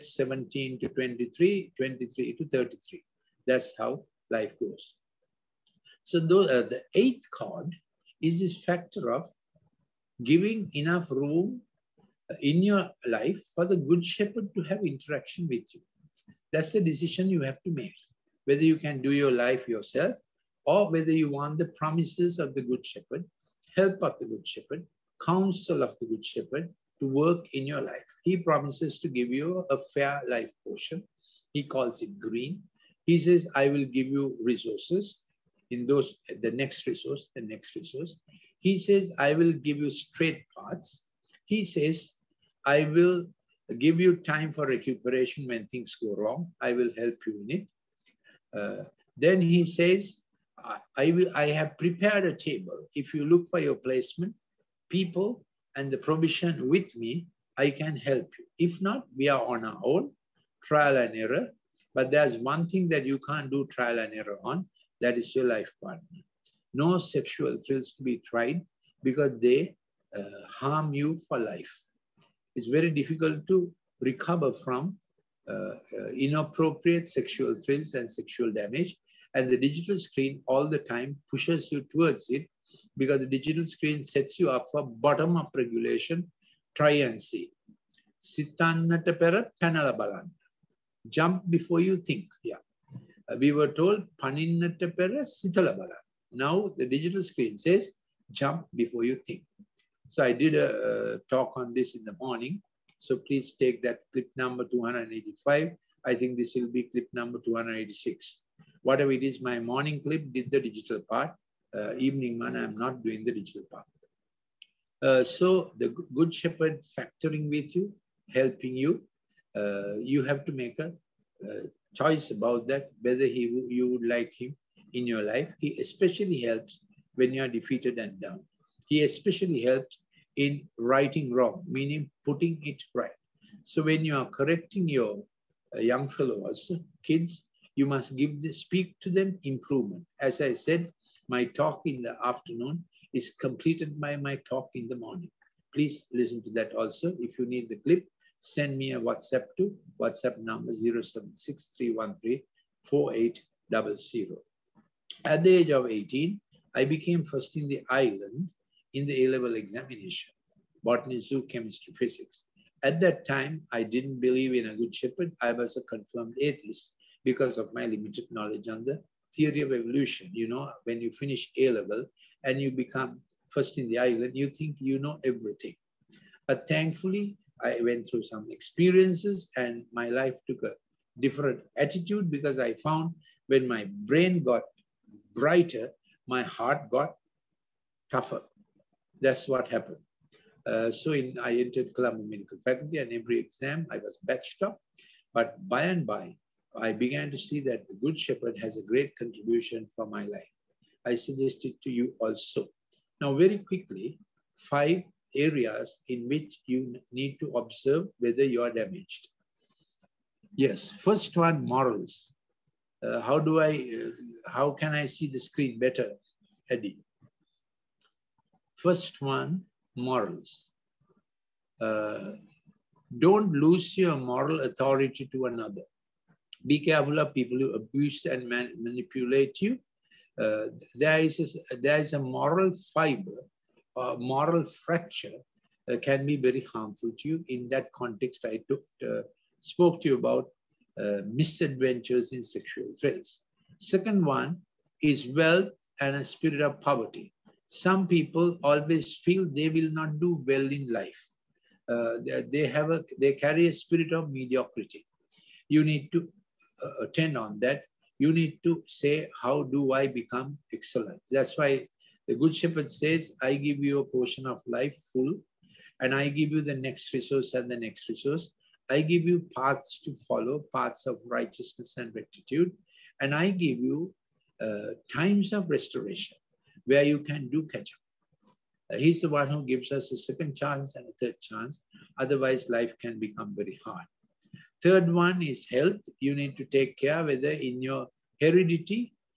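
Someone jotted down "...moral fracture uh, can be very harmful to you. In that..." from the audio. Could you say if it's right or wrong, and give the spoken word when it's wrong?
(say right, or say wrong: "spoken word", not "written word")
right.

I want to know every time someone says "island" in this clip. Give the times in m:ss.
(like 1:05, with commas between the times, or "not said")
2:37, 2:53.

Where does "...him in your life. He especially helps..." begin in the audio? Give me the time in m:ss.
2:04.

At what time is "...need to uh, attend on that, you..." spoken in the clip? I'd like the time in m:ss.
4:15.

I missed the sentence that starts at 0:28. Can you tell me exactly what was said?
He promises to give you a fair life portion.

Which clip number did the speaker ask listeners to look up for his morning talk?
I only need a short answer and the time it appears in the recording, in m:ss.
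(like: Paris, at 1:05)
285, at 1:44.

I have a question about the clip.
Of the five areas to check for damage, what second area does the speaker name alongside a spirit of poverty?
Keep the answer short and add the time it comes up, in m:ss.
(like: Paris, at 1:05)
wealth, at 4:05.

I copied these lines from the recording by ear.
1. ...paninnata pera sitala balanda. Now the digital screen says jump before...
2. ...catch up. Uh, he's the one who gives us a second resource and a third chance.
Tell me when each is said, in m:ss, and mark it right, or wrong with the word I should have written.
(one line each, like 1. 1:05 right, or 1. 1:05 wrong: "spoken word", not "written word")
1. 1:34 right
2. 4:37 wrong: "chance", not "resource".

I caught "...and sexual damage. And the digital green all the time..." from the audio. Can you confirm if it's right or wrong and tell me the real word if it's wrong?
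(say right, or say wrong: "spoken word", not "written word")
wrong: "screen", not "green".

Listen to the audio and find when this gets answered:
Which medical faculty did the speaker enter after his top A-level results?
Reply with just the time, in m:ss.
3:11.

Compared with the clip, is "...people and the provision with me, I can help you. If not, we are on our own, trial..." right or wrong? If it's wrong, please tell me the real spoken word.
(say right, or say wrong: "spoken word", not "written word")
right.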